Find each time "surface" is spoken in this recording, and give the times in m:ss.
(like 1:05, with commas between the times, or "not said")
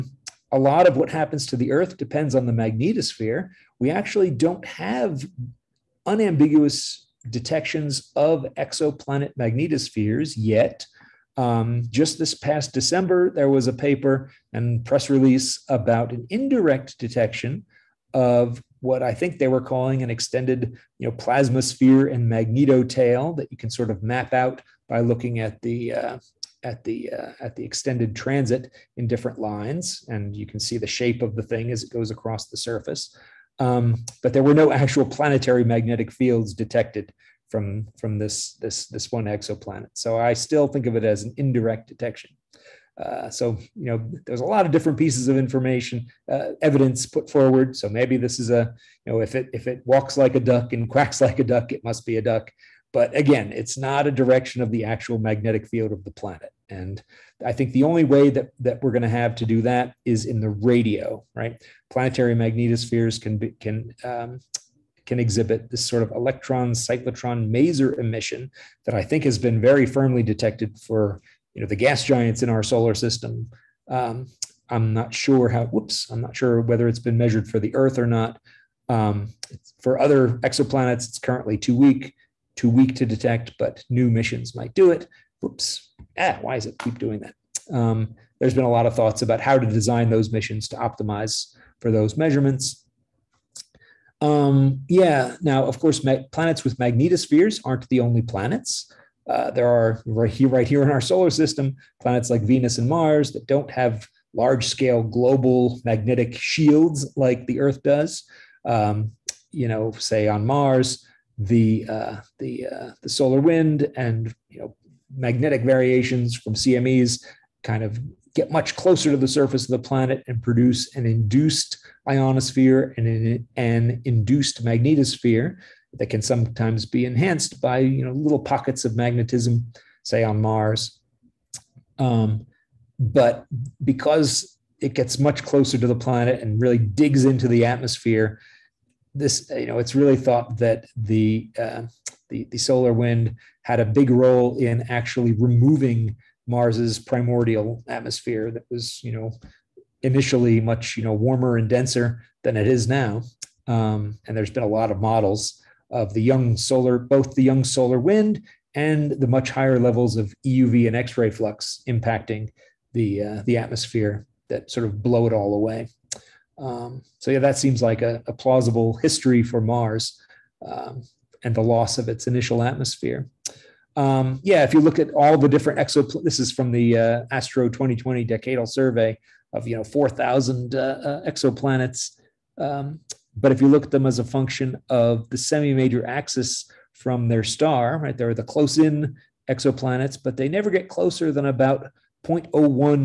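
0:32, 1:59.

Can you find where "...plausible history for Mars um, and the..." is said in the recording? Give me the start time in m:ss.
2:48.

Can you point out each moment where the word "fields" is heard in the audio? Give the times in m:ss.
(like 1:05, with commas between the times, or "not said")
0:36, 0:55.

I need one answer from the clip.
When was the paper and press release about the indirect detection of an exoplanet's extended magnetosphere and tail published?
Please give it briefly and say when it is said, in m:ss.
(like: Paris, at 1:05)
December, at 0:12.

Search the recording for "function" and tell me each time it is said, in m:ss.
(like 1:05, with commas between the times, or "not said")
3:04.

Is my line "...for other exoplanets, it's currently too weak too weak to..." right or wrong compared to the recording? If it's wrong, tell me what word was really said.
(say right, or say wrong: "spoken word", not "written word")
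right.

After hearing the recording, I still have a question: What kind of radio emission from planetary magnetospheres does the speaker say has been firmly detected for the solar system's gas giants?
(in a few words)
electron cyclotron maser emission.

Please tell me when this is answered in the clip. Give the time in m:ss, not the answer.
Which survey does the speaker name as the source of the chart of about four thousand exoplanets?
2:57.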